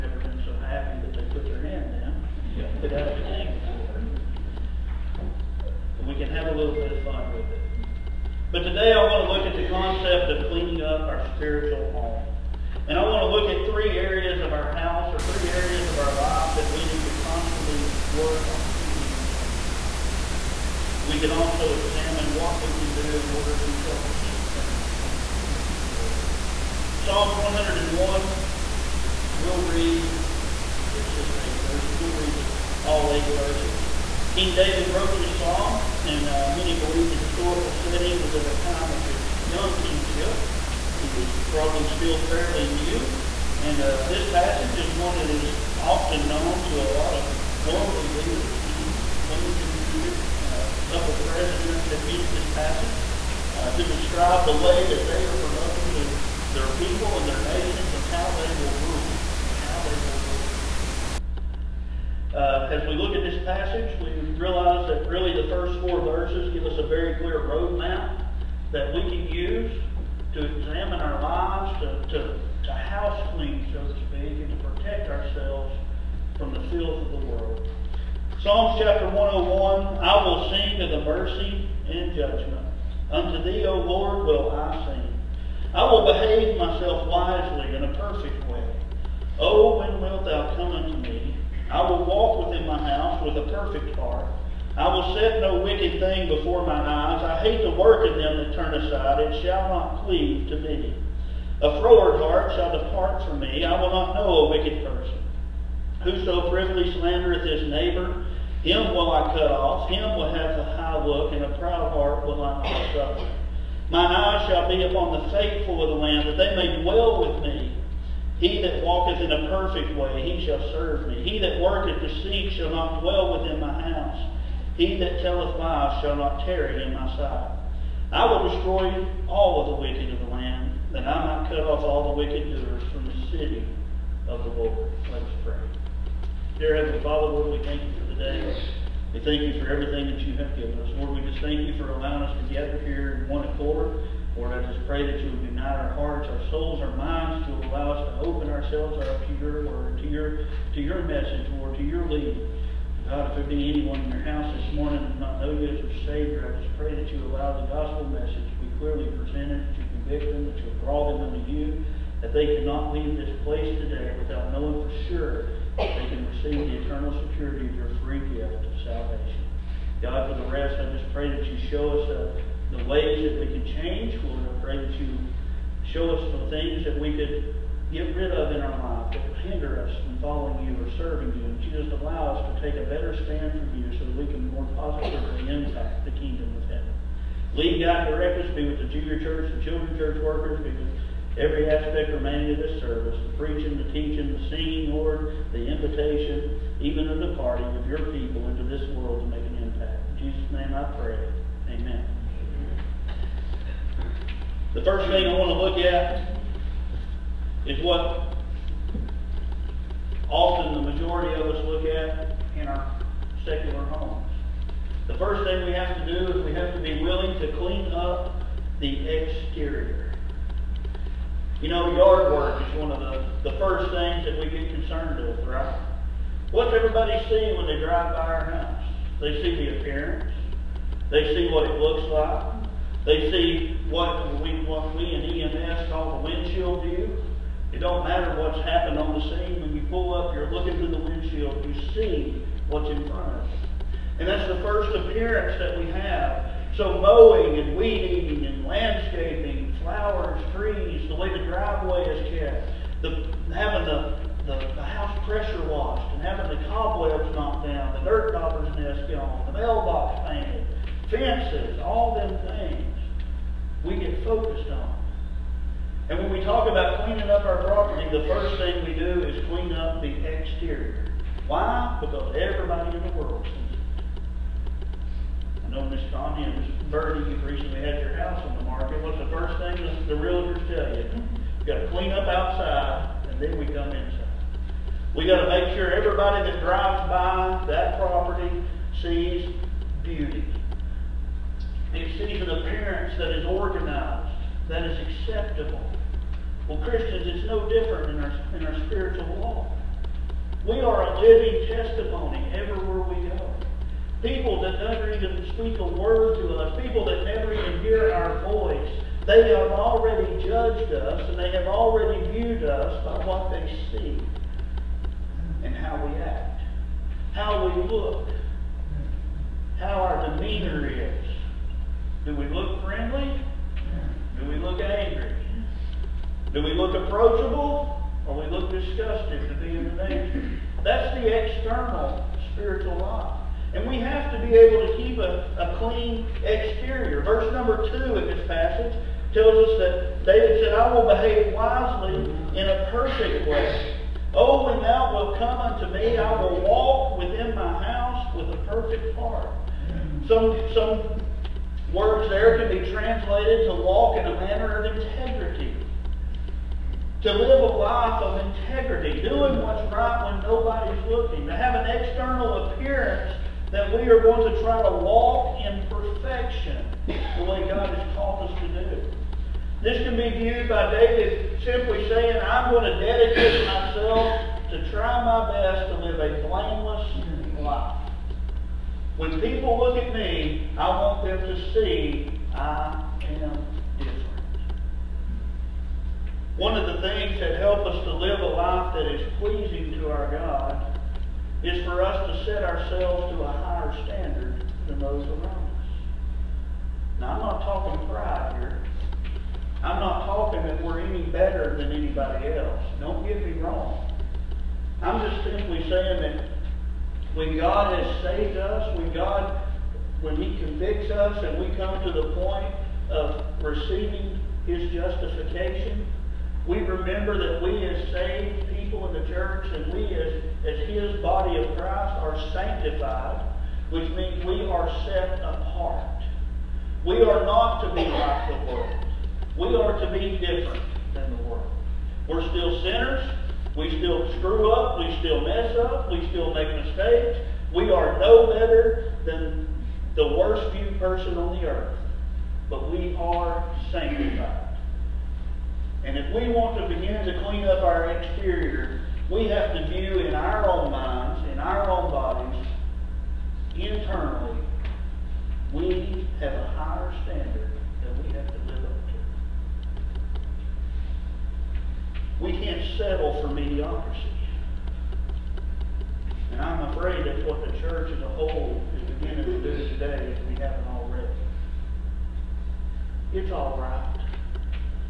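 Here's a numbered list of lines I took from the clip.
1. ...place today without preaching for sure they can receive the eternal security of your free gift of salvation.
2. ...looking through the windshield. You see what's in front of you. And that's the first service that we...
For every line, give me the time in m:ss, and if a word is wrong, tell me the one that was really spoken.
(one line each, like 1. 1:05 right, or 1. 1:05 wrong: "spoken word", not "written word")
1. 2:43 wrong: "knowing", not "preaching"
2. 4:00 wrong: "appearance", not "service".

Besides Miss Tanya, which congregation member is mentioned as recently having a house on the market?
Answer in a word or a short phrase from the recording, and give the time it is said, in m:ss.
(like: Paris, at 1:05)
Miss Birdie, at 4:36.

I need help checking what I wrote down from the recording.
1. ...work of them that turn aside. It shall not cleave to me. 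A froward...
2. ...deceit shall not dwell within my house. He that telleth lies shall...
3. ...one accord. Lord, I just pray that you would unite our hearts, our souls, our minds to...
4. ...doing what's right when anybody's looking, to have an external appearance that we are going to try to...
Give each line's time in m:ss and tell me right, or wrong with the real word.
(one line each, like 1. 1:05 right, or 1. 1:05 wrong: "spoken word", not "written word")
1. 1:37 right
2. 2:02 right
3. 2:23 right
4. 5:59 wrong: "nobody", not "anybody".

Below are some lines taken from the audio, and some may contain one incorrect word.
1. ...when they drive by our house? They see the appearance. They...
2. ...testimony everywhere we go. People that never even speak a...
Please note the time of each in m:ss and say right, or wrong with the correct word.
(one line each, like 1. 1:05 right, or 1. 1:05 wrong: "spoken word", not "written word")
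1. 3:47 right
2. 5:01 right.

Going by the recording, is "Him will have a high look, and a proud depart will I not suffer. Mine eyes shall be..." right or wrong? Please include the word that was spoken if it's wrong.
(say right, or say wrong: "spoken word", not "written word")
wrong: "heart", not "depart".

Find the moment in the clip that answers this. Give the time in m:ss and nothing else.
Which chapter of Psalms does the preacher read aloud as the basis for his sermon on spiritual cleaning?
1:18.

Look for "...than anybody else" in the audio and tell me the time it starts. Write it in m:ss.
6:41.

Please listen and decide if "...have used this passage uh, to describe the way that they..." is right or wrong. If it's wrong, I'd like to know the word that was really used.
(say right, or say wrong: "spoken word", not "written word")
right.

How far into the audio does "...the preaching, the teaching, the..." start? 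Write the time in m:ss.
3:13.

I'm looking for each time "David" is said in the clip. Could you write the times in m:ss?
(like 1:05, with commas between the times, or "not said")
0:34, 5:40, 6:10.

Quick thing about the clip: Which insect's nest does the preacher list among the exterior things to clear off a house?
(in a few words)
dirt dauber.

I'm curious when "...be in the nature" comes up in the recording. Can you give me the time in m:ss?
5:29.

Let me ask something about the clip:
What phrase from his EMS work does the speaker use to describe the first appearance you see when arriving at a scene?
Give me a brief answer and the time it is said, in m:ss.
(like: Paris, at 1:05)
windshield view, at 3:56.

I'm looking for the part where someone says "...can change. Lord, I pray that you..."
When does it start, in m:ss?
2:53.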